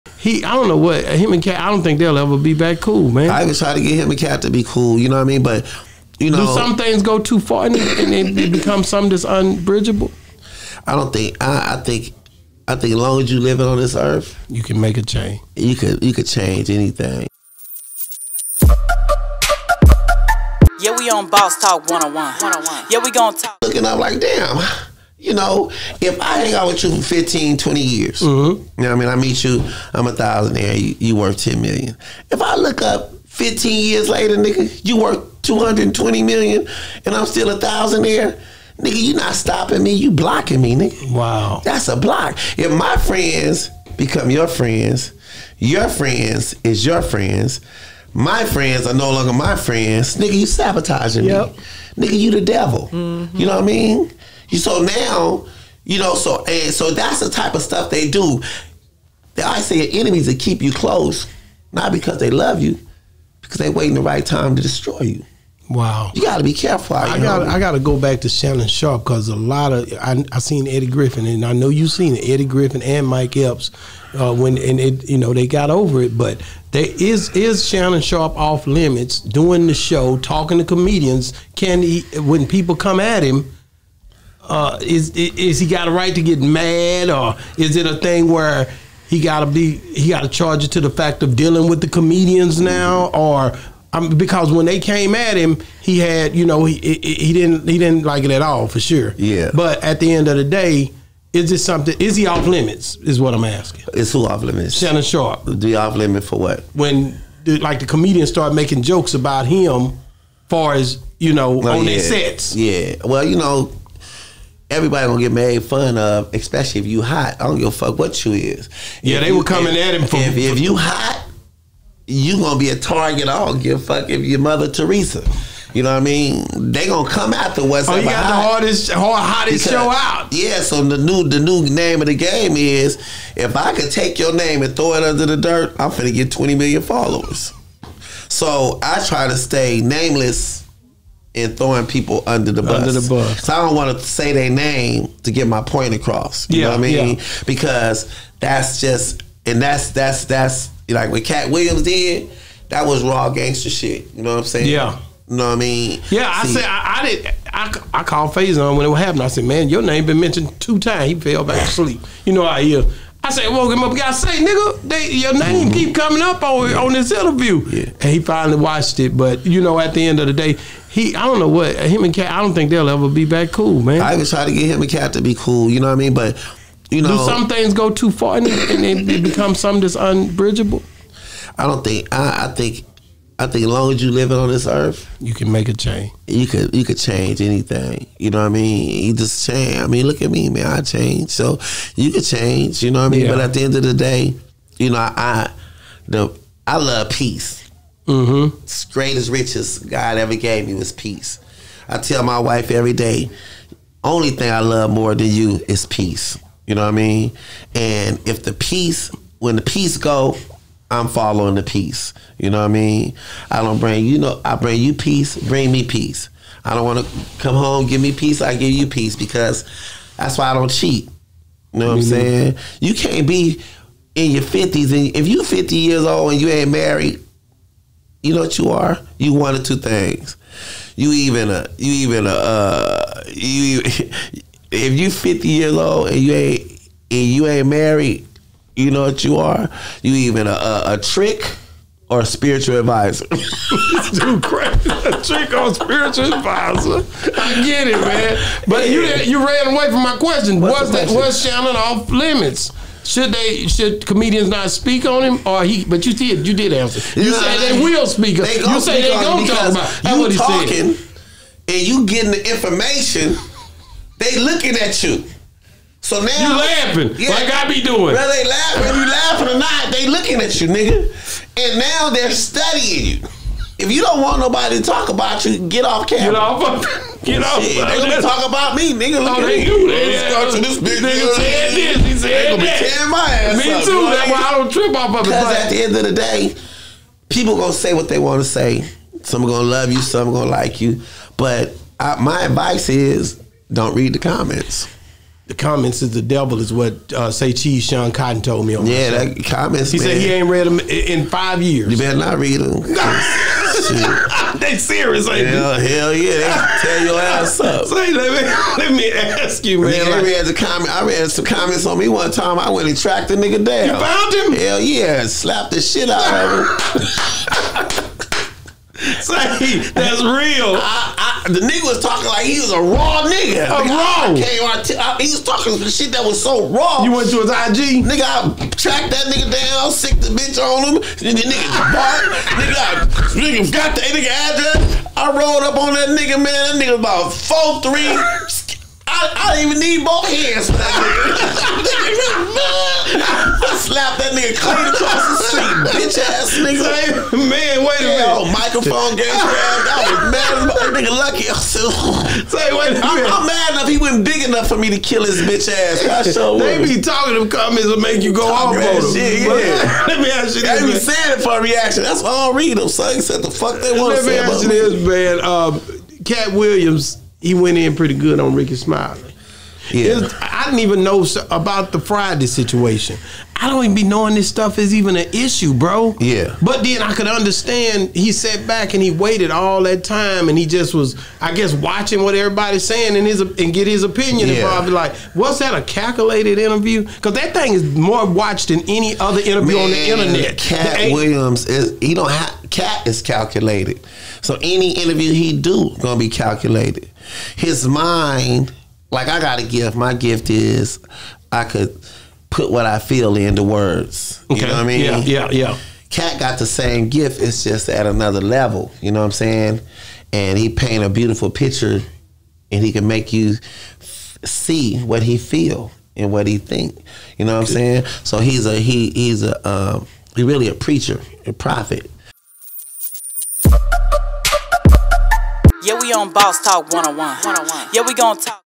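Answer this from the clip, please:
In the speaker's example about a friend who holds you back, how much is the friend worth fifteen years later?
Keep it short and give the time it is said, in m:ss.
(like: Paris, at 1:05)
220 million, at 0:35.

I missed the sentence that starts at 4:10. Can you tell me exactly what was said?
What's was that was Shannon off limits?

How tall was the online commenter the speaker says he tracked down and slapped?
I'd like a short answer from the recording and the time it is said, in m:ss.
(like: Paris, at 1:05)
4'3", at 5:37.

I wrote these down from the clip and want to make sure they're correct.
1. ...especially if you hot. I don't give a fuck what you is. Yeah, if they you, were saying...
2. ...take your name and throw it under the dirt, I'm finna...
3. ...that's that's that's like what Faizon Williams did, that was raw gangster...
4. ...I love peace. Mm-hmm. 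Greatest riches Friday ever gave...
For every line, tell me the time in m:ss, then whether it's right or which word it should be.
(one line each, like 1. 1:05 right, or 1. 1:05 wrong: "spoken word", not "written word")
1. 1:56 wrong: "coming", not "saying"
2. 2:13 right
3. 2:29 wrong: "Katt", not "Faizon"
4. 3:16 wrong: "God", not "Friday".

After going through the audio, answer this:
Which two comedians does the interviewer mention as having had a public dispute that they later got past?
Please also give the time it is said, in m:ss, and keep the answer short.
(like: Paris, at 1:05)
Eddie Griffin and Mike Epps, at 1:12.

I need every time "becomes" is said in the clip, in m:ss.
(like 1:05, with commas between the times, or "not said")
0:08, 0:43, 2:59.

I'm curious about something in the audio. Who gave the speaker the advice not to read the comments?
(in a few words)
Sean Cotton.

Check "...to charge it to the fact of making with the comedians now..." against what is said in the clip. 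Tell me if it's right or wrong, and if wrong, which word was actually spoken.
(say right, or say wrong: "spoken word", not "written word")
wrong: "dealing", not "making".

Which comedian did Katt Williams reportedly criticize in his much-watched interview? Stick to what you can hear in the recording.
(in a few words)
Rickey Smiley.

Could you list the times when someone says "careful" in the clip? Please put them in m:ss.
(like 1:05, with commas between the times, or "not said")
1:06.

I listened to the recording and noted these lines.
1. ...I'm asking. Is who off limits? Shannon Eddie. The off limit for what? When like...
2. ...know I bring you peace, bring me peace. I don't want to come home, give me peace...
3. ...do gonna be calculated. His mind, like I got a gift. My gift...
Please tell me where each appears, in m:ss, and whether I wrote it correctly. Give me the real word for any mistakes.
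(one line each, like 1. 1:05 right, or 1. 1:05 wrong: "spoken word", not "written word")
1. 1:43 wrong: "Sharpe", not "Eddie"
2. 3:34 right
3. 6:35 right.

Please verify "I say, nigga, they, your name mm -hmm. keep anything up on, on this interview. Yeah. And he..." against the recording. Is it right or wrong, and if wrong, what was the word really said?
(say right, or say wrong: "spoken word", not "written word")
wrong: "coming", not "anything".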